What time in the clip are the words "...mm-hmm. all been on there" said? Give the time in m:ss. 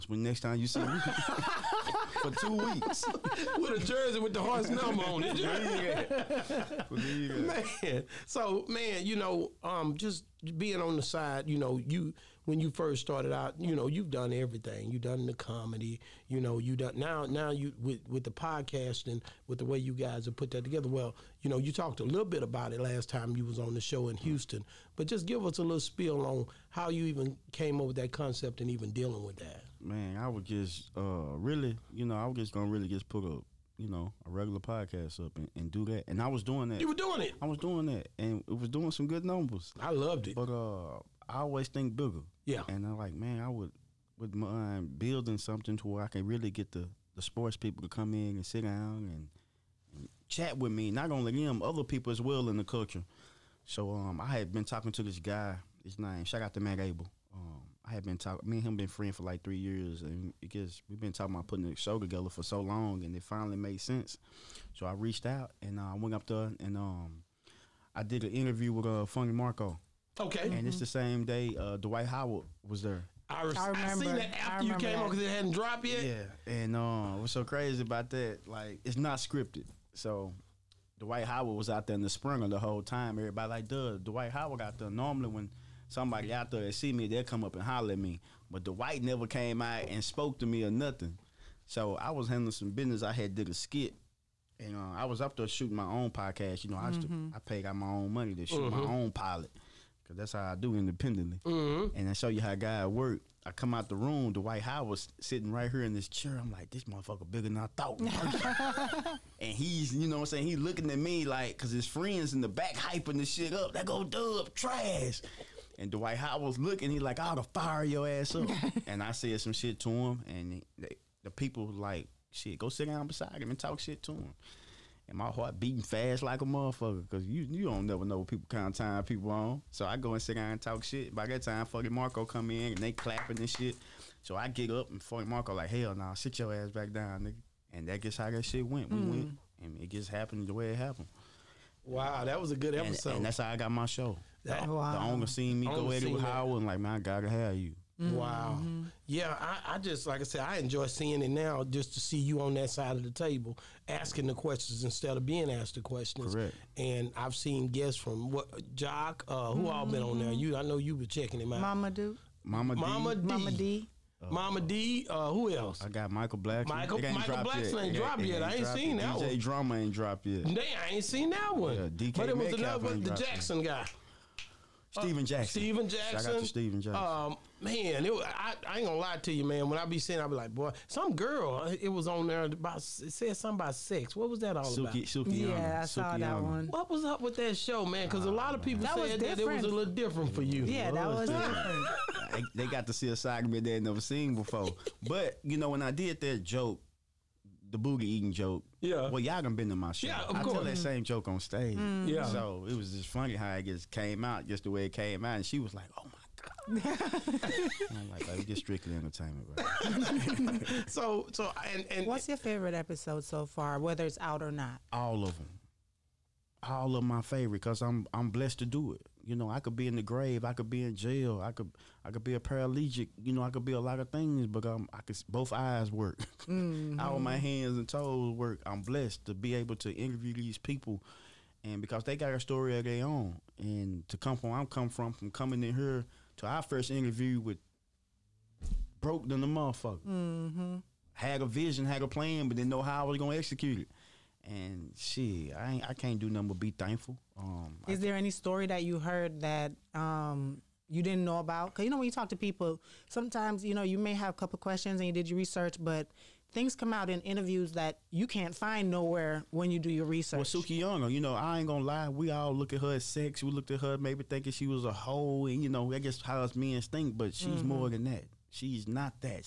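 2:39.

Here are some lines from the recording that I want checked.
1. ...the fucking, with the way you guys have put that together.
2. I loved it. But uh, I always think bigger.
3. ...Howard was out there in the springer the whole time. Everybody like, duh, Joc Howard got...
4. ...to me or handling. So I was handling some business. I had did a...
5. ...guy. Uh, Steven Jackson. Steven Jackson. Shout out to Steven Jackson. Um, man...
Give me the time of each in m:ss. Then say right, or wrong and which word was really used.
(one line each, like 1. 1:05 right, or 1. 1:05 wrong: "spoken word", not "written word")
1. 0:18 wrong: "podcasting", not "fucking"
2. 0:39 right
3. 1:21 wrong: "Dwight", not "Joc"
4. 1:30 wrong: "nothing", not "handling"
5. 2:53 right.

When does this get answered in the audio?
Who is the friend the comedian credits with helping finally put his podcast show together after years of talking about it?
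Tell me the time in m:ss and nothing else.
0:56.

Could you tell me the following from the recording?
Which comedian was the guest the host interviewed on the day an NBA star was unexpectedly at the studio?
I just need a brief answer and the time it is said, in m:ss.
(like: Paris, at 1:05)
Funny Marco, at 1:09.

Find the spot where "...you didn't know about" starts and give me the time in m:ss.
4:10.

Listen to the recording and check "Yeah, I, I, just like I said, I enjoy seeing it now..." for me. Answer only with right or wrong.
right.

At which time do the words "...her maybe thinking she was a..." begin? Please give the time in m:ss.
4:23.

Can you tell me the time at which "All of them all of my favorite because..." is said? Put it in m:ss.
3:34.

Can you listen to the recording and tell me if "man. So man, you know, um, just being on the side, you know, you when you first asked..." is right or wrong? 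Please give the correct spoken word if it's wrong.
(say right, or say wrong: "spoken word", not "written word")
wrong: "started", not "asked".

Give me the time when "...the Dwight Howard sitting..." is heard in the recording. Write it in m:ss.
1:44.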